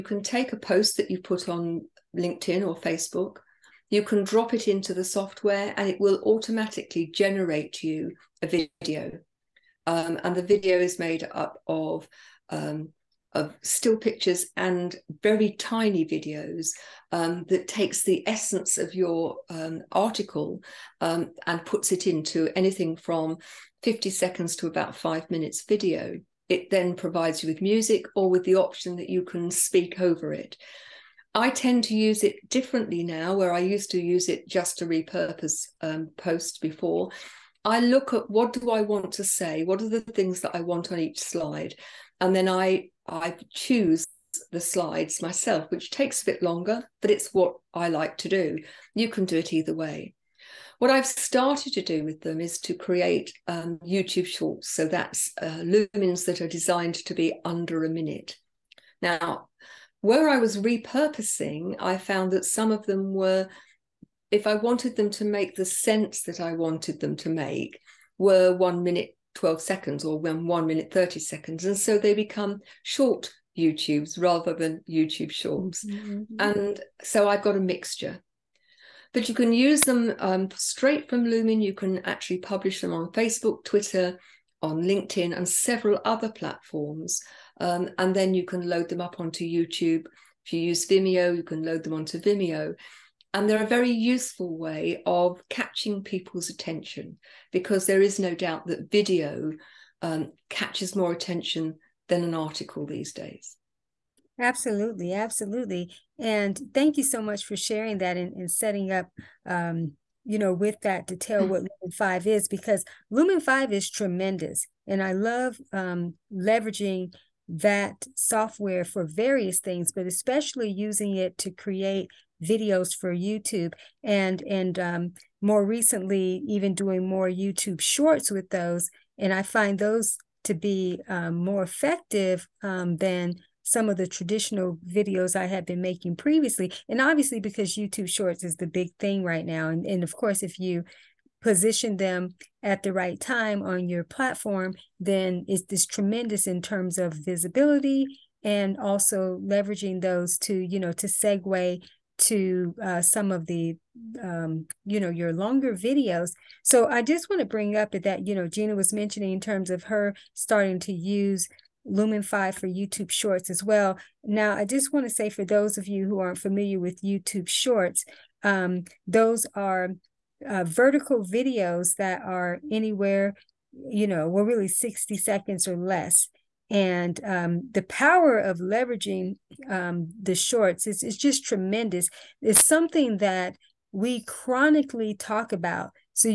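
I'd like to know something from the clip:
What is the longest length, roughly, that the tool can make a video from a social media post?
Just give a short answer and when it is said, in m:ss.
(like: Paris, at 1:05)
5 minutes, at 0:24.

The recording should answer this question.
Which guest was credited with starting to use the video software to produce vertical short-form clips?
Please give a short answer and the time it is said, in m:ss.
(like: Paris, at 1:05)
Gina, at 2:38.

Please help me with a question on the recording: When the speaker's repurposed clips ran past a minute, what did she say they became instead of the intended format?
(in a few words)
short YouTubes.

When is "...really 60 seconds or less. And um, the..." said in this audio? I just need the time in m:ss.
2:54.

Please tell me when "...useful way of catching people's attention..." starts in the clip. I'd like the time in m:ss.
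1:33.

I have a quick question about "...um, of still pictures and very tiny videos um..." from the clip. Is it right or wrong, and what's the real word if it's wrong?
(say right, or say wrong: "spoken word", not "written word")
right.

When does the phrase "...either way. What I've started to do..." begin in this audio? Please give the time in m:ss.
0:49.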